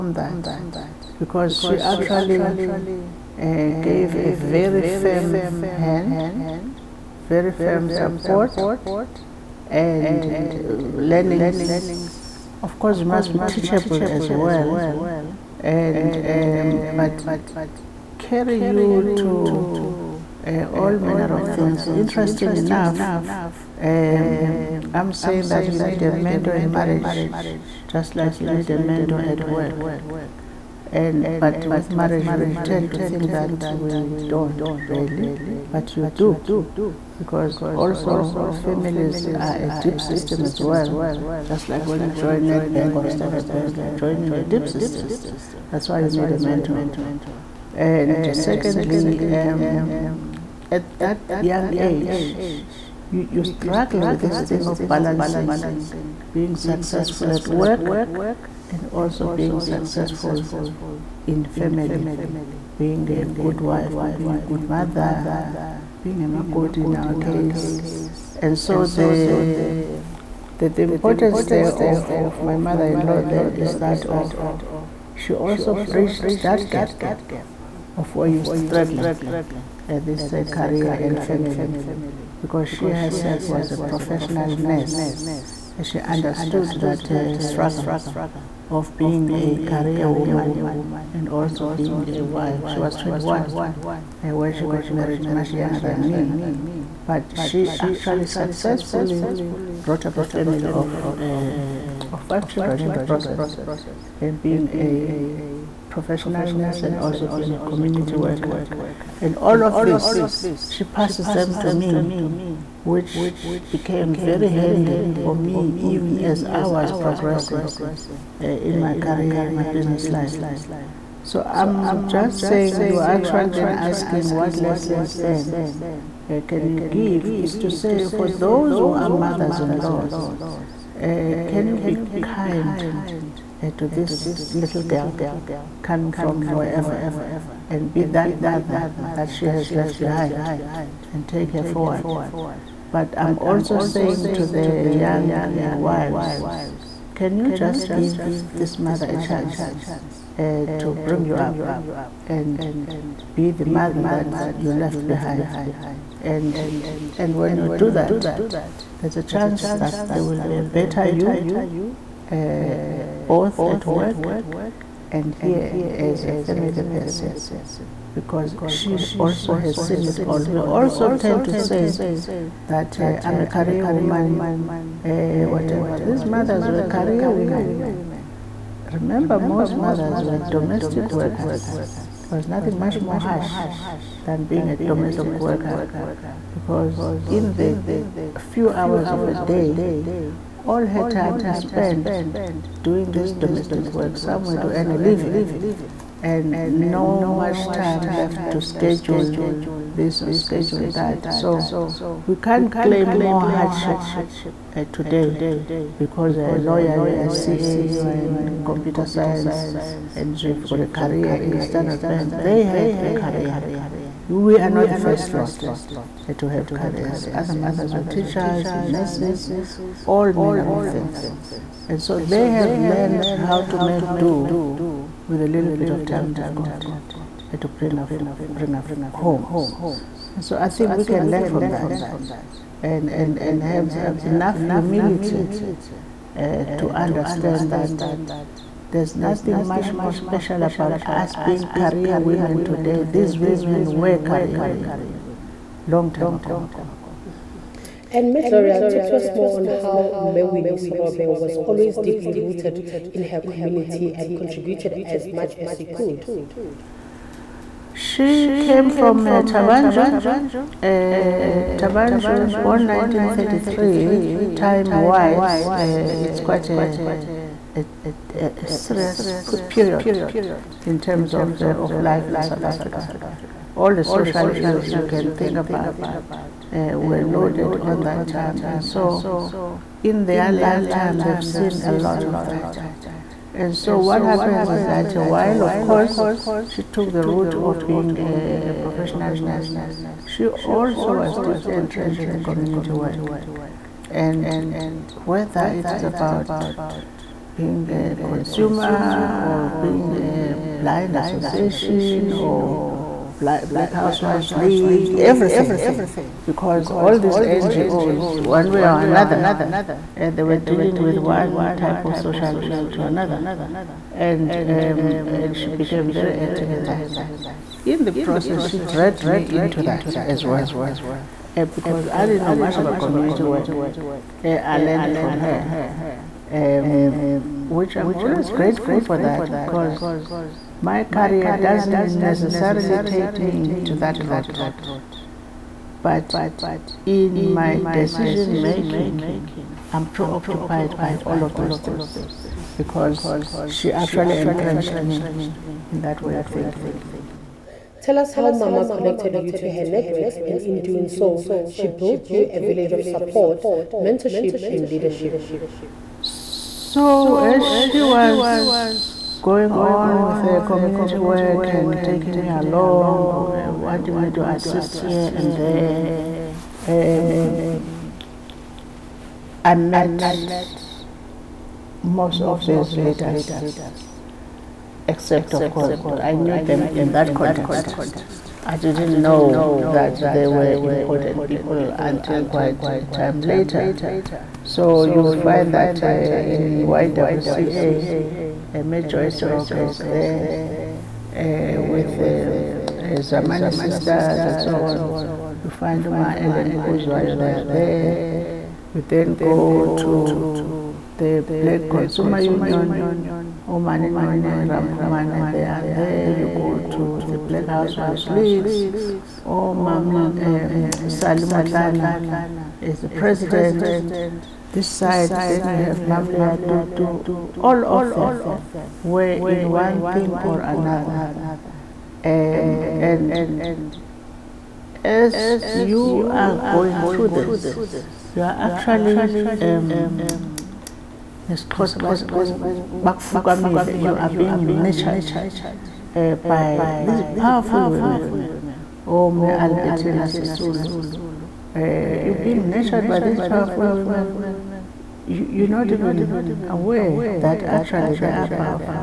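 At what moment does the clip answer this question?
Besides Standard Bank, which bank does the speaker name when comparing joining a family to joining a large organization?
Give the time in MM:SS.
00:42.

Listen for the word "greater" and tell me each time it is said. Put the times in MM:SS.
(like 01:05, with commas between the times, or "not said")
not said.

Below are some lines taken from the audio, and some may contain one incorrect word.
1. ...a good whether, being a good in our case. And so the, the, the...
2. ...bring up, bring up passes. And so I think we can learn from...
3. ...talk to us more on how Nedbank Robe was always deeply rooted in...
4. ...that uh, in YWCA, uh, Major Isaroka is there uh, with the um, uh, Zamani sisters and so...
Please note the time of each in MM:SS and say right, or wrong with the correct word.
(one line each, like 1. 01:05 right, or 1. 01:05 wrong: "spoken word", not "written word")
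1. 01:04 wrong: "mother", not "whether"
2. 03:47 wrong: "homes", not "passes"
3. 04:08 wrong: "Mewinis", not "Nedbank"
4. 06:25 right.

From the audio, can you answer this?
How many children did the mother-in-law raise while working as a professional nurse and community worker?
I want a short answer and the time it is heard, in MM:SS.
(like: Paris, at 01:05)
5, at 01:42.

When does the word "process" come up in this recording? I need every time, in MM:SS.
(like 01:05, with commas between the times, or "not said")
01:43, 05:18.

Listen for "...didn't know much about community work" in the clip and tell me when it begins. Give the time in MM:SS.
05:22.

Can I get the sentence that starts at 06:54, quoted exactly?
This side, then you have Mamlea Tutu, all of them were in one thing or another.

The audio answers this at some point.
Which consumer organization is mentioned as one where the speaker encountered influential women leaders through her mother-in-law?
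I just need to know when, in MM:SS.
06:41.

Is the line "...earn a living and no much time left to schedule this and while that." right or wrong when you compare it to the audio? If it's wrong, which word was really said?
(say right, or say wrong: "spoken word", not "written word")
wrong: "schedule", not "while".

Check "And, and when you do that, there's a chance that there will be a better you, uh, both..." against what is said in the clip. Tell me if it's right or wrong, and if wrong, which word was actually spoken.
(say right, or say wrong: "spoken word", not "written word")
right.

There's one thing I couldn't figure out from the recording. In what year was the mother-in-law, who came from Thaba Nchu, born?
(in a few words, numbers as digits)
1933.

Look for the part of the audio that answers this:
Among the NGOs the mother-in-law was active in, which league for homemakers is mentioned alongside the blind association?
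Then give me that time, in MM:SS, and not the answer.
05:03.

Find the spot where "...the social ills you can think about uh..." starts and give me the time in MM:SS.
04:33.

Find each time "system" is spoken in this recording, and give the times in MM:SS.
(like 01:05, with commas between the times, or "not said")
00:40, 00:44.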